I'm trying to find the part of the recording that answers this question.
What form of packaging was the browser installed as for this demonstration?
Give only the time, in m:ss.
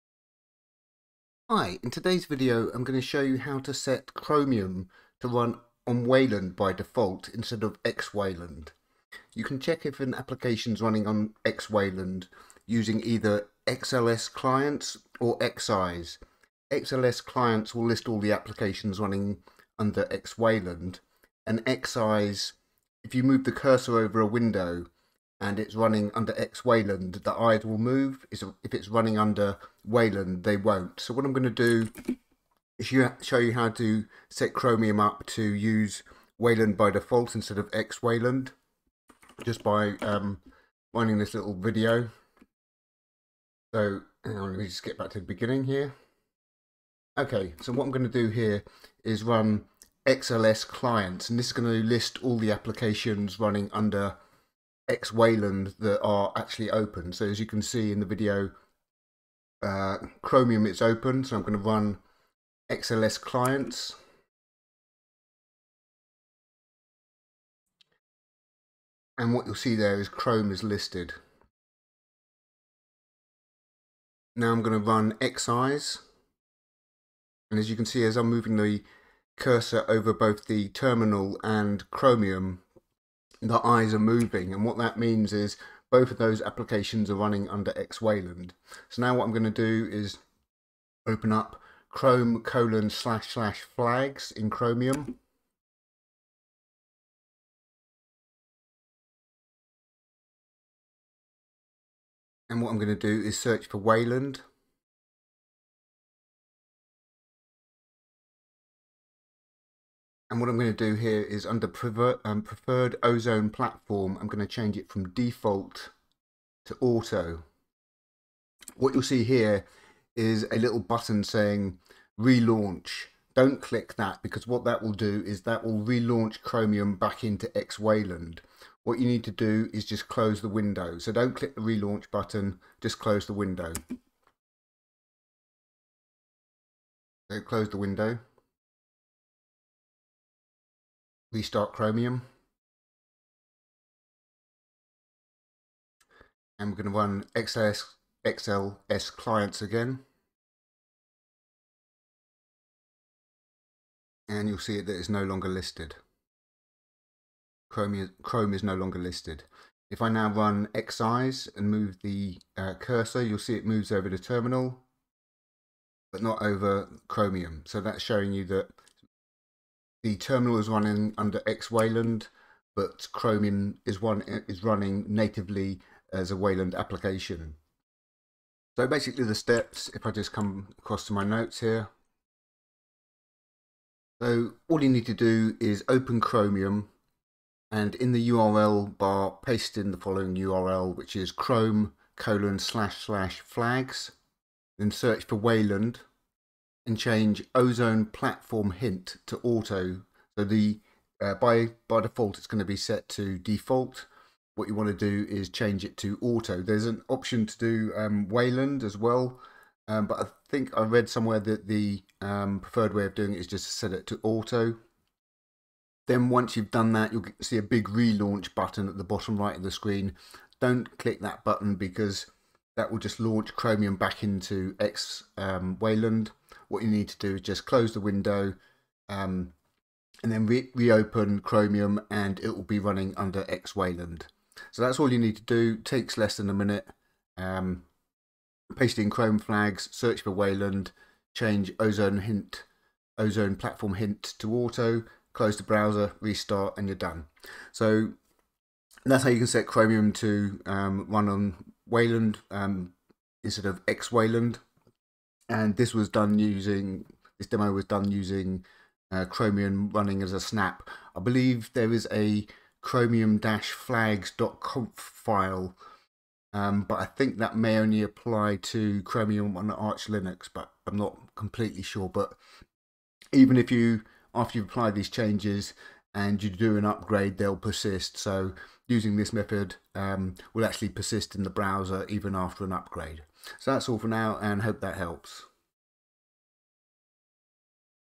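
4:20.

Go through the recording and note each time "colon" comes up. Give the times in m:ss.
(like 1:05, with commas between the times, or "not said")
1:32, 3:12.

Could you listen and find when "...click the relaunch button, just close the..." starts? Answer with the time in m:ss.
2:11.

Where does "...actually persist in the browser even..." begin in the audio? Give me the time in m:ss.
4:40.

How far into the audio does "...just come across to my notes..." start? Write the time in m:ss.
3:00.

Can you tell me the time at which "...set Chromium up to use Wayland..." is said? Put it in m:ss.
0:34.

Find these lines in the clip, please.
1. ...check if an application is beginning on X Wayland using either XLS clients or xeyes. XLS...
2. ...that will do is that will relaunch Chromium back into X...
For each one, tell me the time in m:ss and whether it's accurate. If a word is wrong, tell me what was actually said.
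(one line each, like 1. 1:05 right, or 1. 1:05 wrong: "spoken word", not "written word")
1. 0:09 wrong: "running", not "beginning"
2. 2:04 right.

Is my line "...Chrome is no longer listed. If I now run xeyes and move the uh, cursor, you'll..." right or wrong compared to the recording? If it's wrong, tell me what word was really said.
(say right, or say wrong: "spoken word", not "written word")
right.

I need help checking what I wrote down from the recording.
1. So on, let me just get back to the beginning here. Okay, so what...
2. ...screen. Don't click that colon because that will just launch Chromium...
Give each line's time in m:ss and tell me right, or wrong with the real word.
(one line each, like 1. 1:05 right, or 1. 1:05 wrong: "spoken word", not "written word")
1. 0:43 right
2. 3:39 wrong: "button", not "colon".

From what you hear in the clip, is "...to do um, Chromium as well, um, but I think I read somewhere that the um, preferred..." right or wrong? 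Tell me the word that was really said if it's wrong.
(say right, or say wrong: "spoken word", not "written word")
wrong: "Wayland", not "Chromium".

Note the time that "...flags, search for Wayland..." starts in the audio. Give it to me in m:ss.
3:59.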